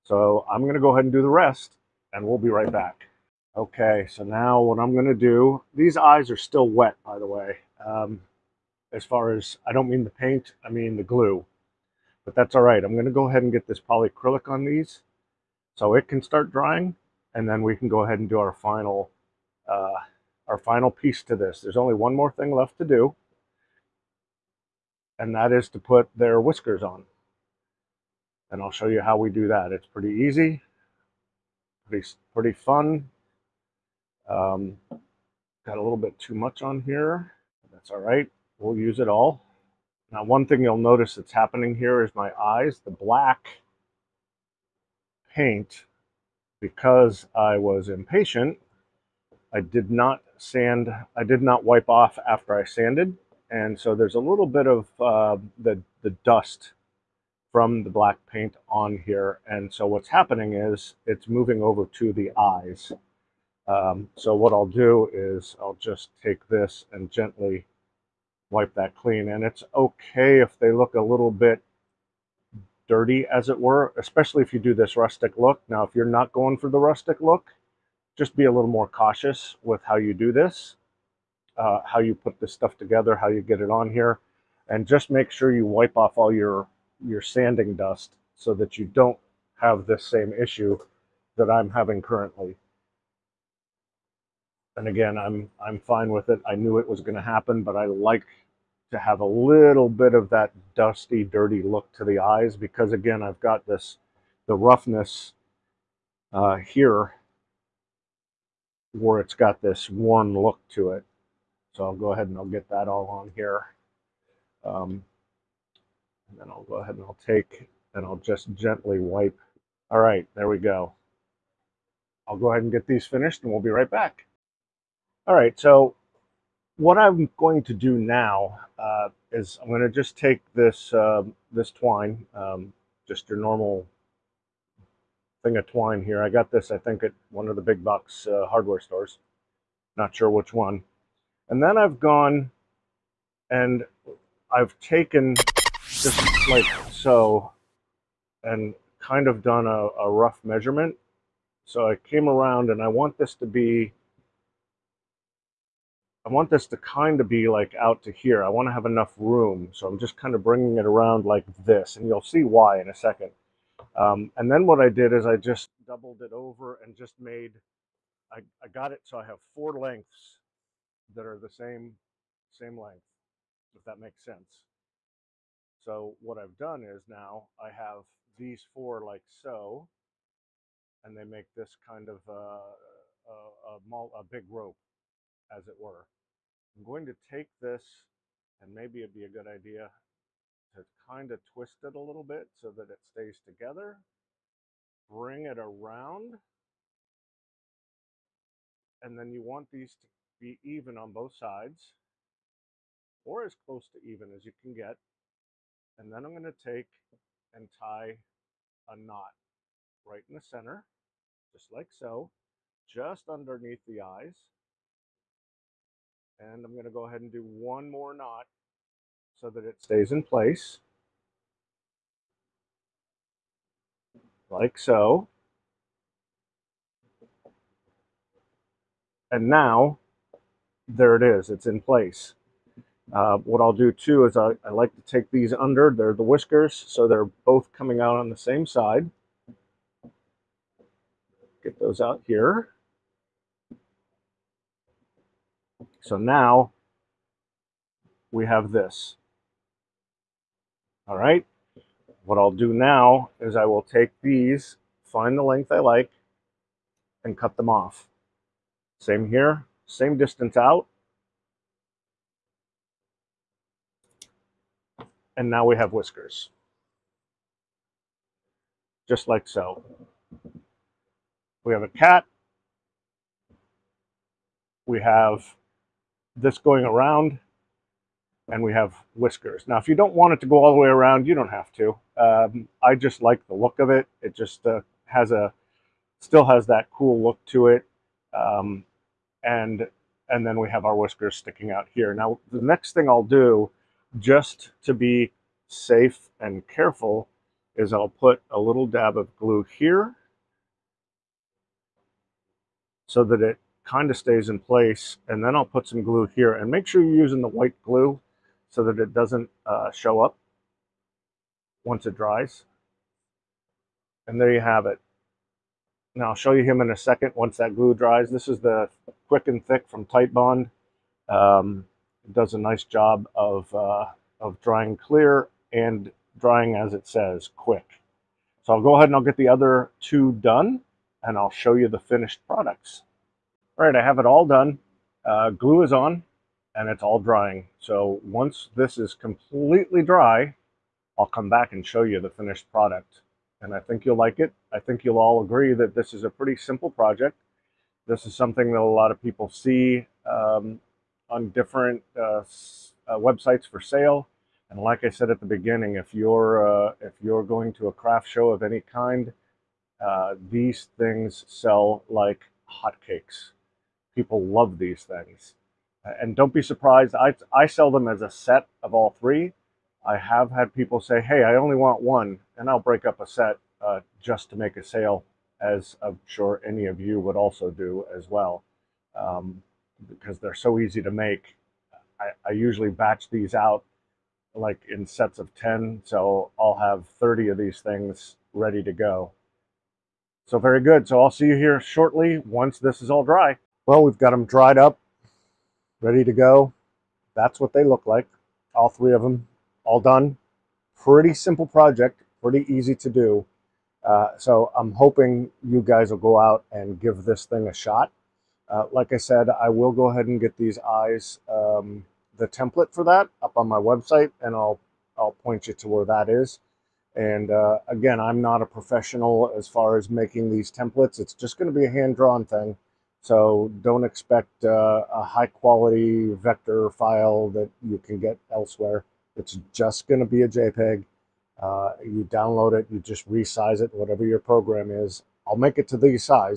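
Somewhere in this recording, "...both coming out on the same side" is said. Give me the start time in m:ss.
3:57.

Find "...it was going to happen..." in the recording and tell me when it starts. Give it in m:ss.
1:36.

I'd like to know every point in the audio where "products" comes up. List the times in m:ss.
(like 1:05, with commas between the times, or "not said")
5:32, 5:42.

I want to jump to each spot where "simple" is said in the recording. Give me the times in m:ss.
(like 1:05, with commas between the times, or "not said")
5:46, 6:41.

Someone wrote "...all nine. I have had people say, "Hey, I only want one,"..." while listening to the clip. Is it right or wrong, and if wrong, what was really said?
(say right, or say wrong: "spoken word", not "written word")
wrong: "three", not "nine".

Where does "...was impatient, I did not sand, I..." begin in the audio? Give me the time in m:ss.
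0:47.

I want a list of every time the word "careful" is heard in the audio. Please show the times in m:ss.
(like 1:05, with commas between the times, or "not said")
4:56.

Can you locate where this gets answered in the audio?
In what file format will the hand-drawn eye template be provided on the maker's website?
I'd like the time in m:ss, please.
7:10.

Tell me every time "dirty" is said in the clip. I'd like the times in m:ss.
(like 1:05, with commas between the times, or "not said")
1:12, 1:41.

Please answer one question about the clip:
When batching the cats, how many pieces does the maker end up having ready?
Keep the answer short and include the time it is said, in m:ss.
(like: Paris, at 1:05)
30, at 6:27.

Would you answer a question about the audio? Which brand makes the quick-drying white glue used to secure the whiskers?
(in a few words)
Titebond.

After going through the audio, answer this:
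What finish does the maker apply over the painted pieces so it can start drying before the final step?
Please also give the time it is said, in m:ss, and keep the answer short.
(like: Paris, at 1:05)
polyacrylic, at 0:13.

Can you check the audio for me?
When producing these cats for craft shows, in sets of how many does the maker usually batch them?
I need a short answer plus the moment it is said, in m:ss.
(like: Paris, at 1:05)
10, at 6:25.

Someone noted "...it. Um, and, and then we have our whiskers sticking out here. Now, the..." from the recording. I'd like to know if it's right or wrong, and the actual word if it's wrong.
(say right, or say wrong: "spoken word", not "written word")
right.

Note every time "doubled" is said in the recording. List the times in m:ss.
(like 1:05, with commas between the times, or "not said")
2:45.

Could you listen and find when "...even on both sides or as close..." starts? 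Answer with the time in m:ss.
3:20.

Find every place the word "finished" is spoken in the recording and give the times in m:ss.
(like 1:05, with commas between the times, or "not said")
2:03, 5:31, 5:42.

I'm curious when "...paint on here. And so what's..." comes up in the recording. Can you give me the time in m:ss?
0:58.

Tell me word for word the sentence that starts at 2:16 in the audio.
I got this, I think, at one of the big box uh, hardware stores.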